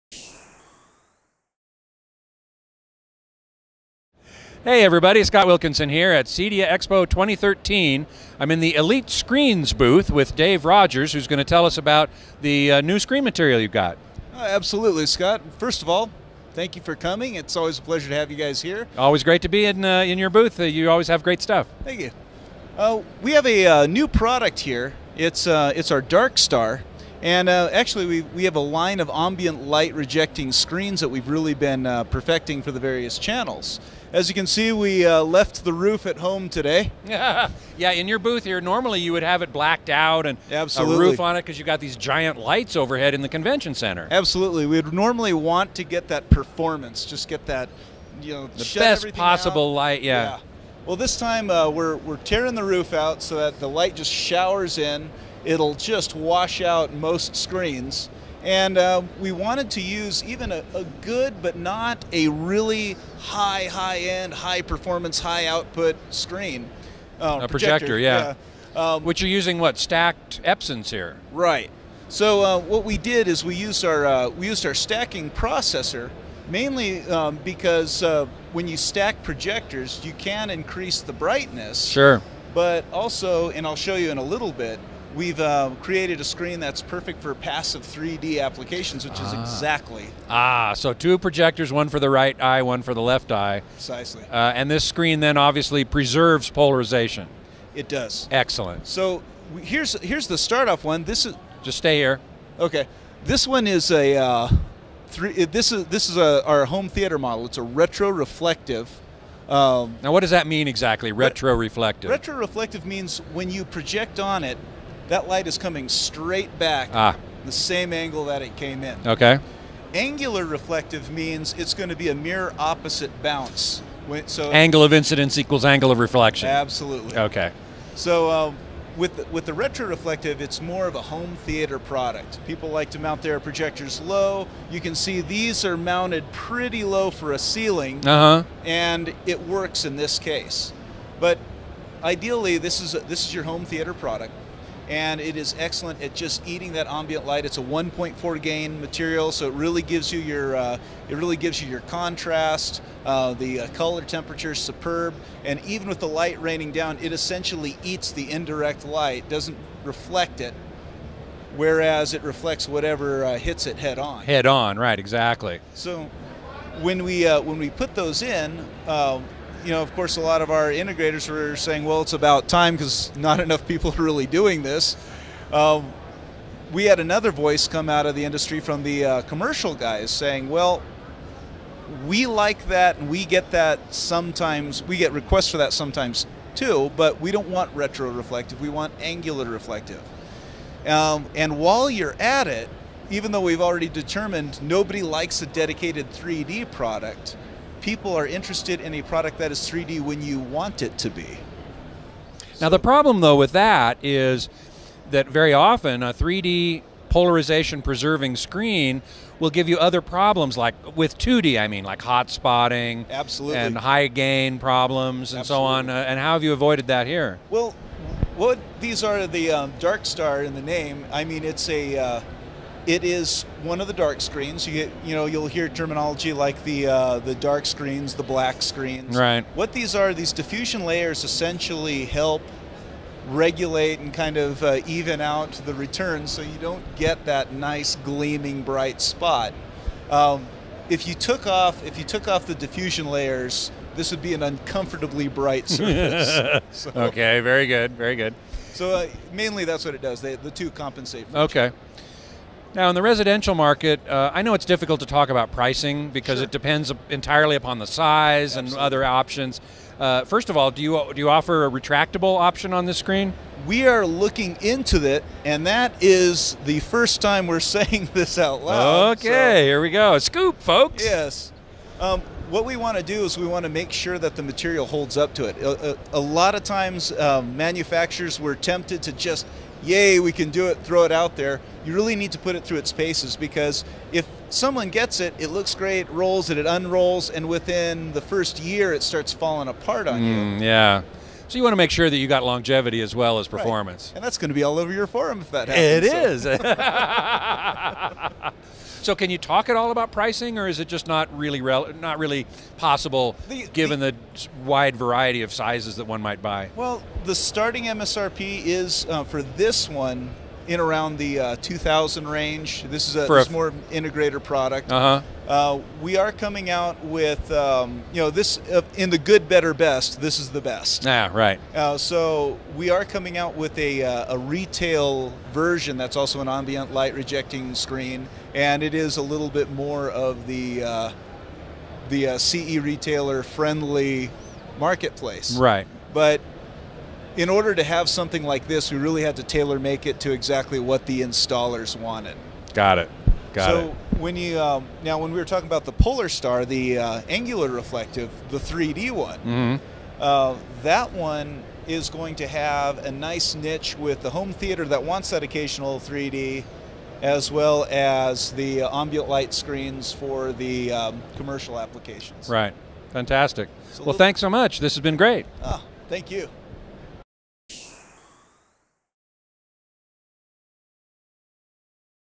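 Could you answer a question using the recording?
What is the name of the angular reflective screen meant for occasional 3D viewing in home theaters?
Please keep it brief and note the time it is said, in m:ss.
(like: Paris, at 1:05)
Polar Star, at 5:45.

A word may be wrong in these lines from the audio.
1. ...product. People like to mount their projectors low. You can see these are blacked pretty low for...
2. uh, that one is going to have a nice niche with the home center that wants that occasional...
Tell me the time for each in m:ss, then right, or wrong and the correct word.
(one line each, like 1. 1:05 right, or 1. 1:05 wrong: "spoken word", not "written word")
1. 2:11 wrong: "mounted", not "blacked"
2. 5:50 wrong: "theater", not "center".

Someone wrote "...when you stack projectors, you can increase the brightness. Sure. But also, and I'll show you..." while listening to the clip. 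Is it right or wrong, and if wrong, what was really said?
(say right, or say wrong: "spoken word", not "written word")
right.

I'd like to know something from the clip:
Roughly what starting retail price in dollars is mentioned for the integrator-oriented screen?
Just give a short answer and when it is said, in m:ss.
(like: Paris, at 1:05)
2000, at 5:11.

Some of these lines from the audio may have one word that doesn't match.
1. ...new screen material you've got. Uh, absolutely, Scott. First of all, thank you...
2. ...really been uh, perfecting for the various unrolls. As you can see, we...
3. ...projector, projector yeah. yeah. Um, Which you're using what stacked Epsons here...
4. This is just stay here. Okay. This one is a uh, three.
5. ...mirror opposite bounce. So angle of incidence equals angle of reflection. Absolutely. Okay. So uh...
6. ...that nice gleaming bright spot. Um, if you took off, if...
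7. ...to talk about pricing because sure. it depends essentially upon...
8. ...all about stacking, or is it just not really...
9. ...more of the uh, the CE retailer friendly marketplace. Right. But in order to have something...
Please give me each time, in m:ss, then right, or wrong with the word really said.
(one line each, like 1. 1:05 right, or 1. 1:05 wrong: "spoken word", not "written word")
1. 0:12 right
2. 0:31 wrong: "channels", not "unrolls"
3. 1:07 right
4. 1:41 right
5. 2:02 right
6. 3:57 right
7. 4:15 wrong: "entirely", not "essentially"
8. 4:59 wrong: "pricing", not "stacking"
9. 5:29 right.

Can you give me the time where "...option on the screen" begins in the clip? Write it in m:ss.
4:22.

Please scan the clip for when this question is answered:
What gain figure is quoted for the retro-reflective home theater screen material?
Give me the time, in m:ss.
2:27.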